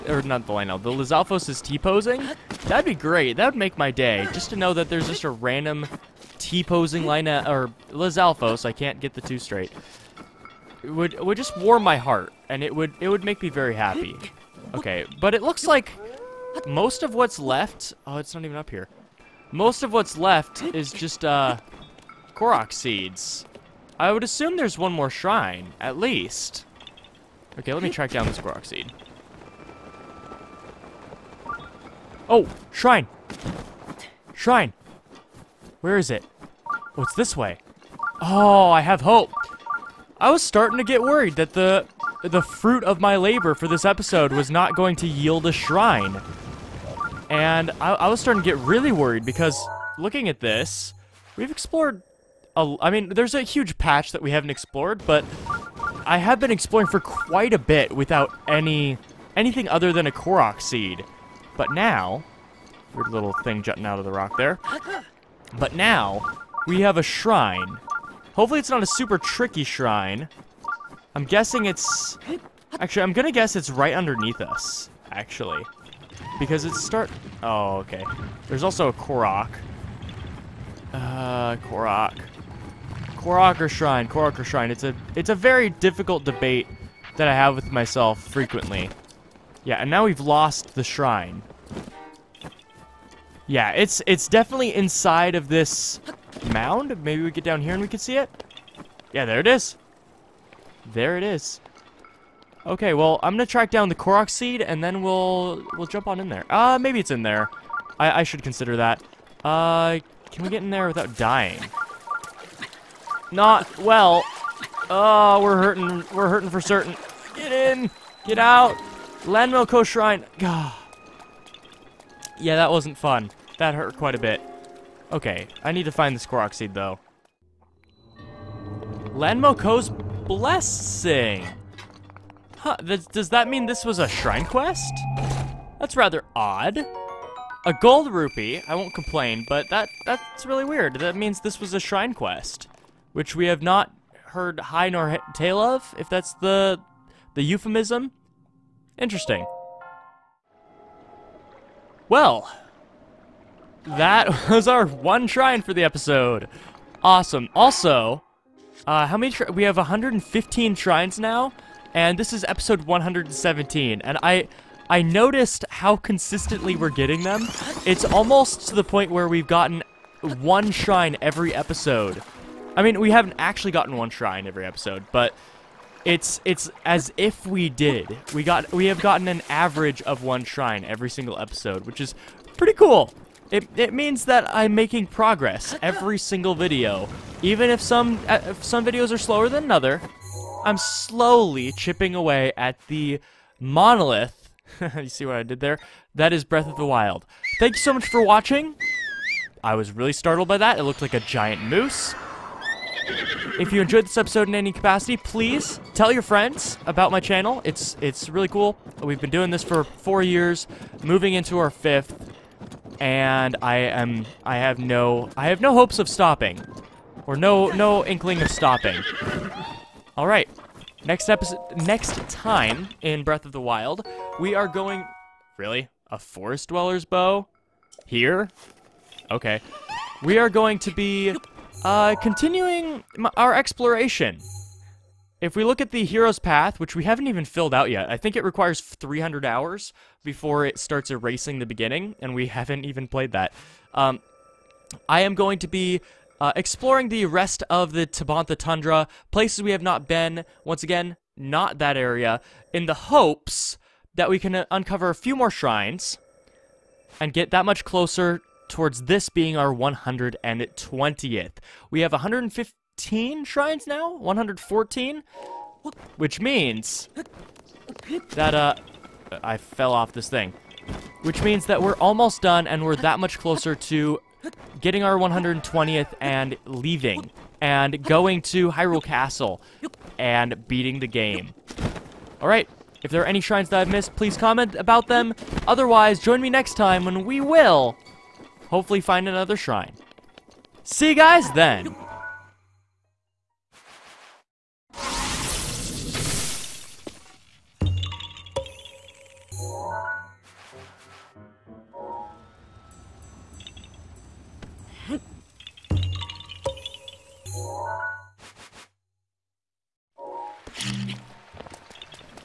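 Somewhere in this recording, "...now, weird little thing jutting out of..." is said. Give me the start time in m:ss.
1:01.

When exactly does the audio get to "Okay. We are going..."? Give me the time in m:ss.
3:49.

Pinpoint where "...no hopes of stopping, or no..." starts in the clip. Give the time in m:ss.
3:35.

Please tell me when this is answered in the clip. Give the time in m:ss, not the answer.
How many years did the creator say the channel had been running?
3:29.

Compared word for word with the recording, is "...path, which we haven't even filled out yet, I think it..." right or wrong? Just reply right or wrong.
right.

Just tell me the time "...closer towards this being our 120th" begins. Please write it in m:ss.
4:17.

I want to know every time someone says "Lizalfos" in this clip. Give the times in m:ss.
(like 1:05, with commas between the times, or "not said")
0:00, 0:07.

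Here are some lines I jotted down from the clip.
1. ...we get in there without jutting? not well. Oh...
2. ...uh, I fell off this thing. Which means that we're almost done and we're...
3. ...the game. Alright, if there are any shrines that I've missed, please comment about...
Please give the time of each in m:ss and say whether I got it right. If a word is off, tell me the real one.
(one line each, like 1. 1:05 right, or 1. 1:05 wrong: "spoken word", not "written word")
1. 1:50 wrong: "dying", not "jutting"
2. 4:28 right
3. 4:40 right.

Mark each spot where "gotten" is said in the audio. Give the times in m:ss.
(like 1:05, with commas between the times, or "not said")
2:49, 2:53, 2:58.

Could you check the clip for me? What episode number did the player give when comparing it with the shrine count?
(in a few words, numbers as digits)
117.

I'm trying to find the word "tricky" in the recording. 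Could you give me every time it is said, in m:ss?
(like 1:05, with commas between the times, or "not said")
1:09.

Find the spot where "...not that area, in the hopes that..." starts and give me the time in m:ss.
4:11.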